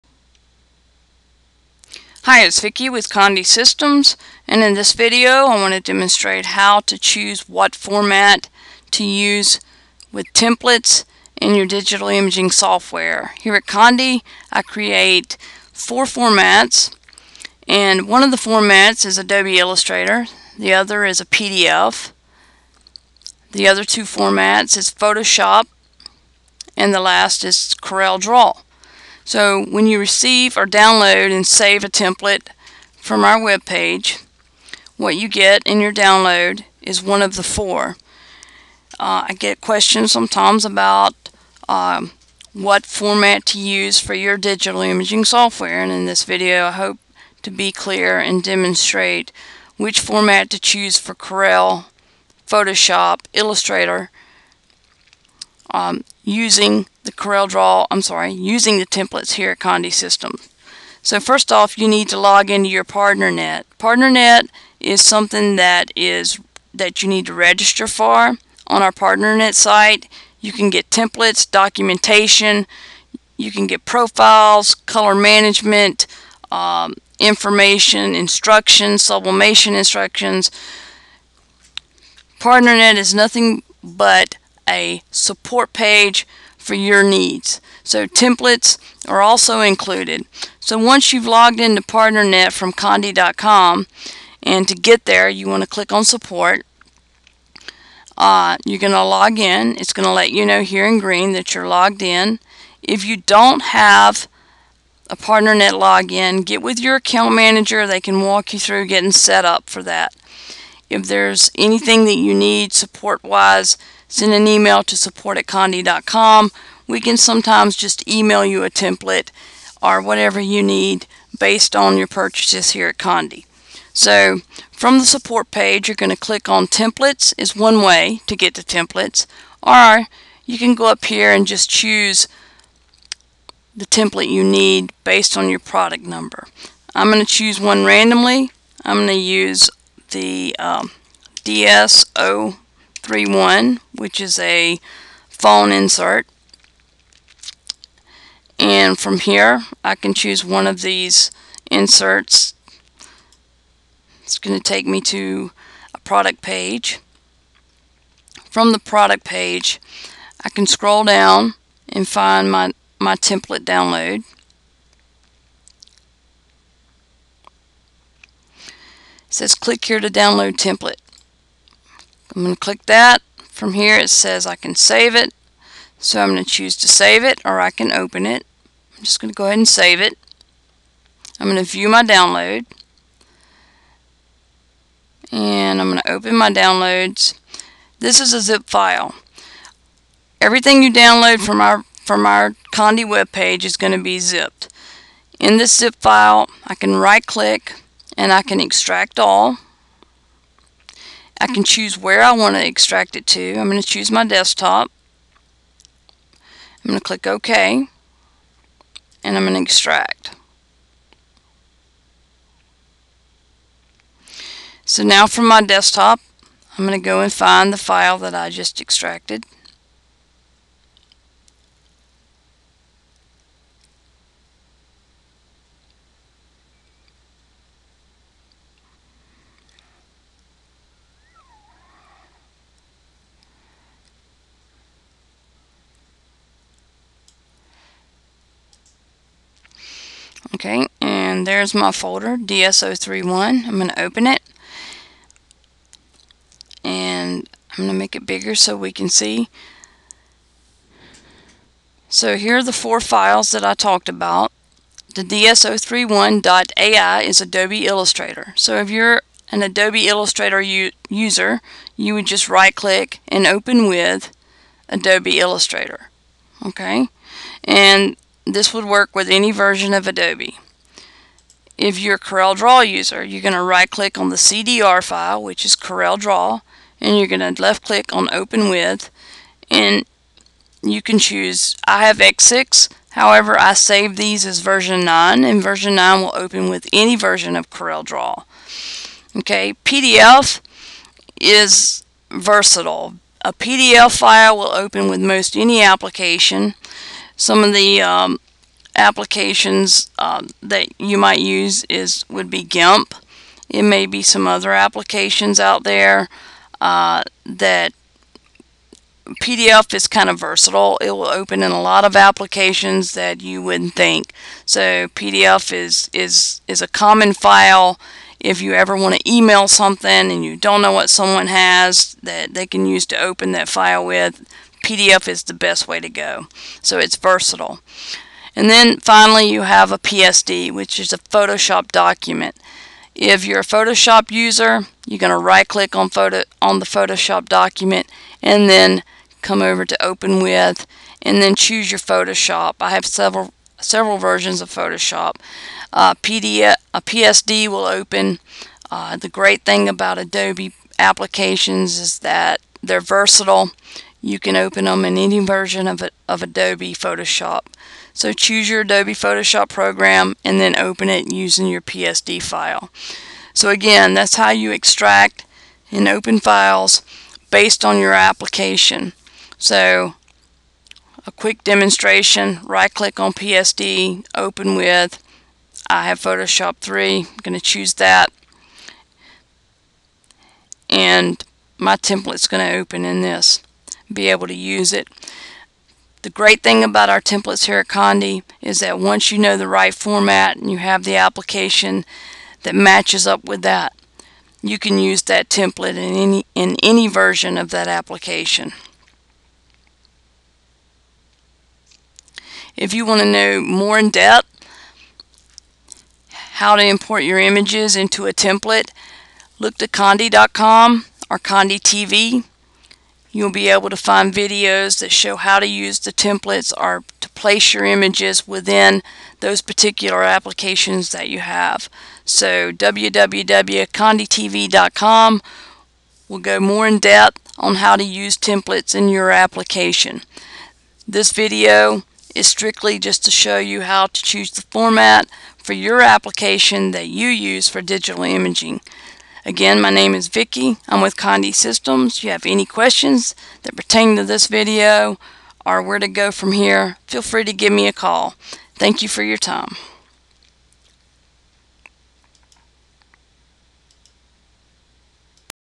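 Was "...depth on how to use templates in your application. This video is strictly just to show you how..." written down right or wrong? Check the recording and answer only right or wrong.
right.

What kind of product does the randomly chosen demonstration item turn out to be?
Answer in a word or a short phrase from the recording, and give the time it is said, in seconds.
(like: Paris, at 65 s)
Phone insert, at 145 s.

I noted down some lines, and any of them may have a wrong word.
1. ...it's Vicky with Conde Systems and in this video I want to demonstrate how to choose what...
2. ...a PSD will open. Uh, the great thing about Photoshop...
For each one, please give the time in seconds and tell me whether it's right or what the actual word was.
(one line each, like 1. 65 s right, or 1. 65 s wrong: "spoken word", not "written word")
1. 2 s right
2. 346 s wrong: "Adobe", not "Photoshop".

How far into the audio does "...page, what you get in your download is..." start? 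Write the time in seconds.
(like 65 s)
33 s.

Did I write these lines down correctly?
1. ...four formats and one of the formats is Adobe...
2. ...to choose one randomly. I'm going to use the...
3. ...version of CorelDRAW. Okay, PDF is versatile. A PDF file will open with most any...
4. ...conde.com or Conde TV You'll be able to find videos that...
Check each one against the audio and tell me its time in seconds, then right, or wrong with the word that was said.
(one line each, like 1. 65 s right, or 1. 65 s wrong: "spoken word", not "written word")
1. 15 s right
2. 137 s right
3. 287 s right
4. 409 s right.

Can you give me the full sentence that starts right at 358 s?
So choose your Adobe Photoshop program and then open it using your PSD file.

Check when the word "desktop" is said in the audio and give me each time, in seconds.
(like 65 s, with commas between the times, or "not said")
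204 s, 215 s.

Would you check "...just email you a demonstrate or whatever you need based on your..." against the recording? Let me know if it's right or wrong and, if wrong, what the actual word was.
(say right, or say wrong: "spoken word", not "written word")
wrong: "template", not "demonstrate".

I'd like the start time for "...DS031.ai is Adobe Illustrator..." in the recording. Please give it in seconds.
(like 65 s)
255 s.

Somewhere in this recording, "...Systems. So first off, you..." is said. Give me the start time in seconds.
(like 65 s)
59 s.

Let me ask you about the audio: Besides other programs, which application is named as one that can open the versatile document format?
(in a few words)
GIMP.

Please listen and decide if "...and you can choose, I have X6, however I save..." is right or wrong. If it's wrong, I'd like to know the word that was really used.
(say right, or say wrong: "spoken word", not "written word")
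right.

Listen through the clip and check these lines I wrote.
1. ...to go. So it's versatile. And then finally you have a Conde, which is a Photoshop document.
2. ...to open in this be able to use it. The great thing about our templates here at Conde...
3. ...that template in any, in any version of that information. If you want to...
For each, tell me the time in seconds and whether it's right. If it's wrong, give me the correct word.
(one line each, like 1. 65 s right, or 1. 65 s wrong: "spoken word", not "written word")
1. 325 s wrong: "PSD", not "Conde"
2. 382 s right
3. 395 s wrong: "application", not "information".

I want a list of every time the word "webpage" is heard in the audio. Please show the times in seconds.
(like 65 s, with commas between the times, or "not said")
193 s.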